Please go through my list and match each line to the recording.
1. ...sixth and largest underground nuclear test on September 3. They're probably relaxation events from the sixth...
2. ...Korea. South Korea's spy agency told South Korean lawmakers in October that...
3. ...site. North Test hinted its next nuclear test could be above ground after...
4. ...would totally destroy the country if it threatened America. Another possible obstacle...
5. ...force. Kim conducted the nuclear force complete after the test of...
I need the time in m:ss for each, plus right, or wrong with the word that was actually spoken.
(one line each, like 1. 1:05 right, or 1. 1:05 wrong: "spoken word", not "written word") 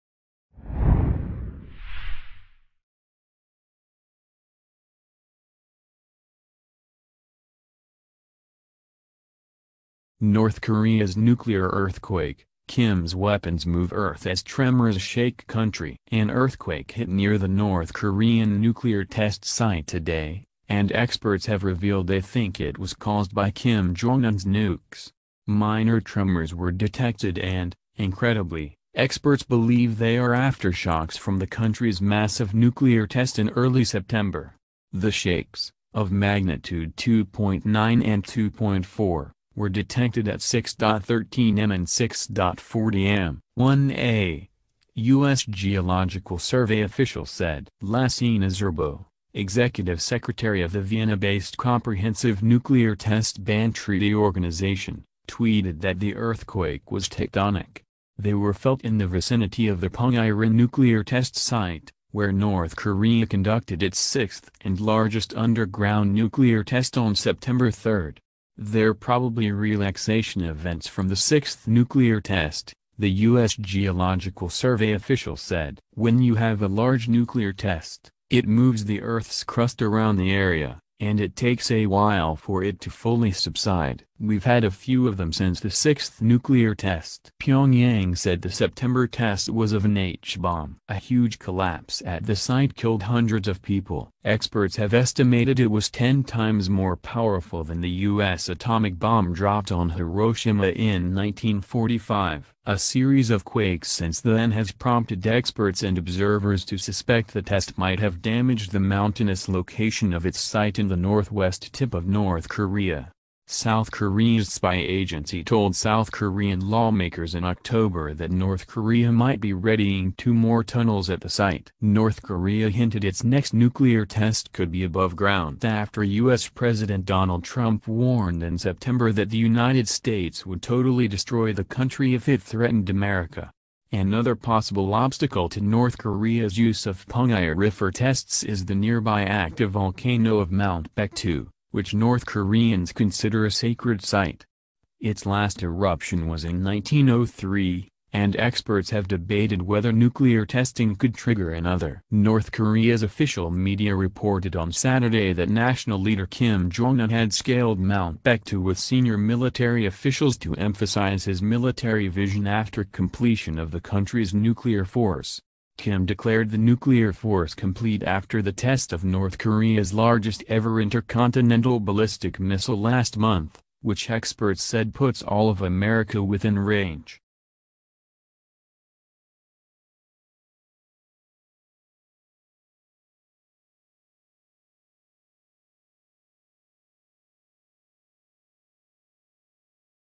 1. 1:03 right
2. 1:52 right
3. 2:01 wrong: "Korea", not "Test"
4. 2:10 right
5. 2:44 wrong: "declared", not "conducted".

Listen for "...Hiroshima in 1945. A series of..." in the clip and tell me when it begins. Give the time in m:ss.
1:39.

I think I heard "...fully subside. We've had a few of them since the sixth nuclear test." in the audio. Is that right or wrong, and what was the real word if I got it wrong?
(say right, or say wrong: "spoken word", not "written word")
right.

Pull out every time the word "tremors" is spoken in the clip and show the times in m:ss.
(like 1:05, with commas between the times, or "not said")
0:14, 0:25.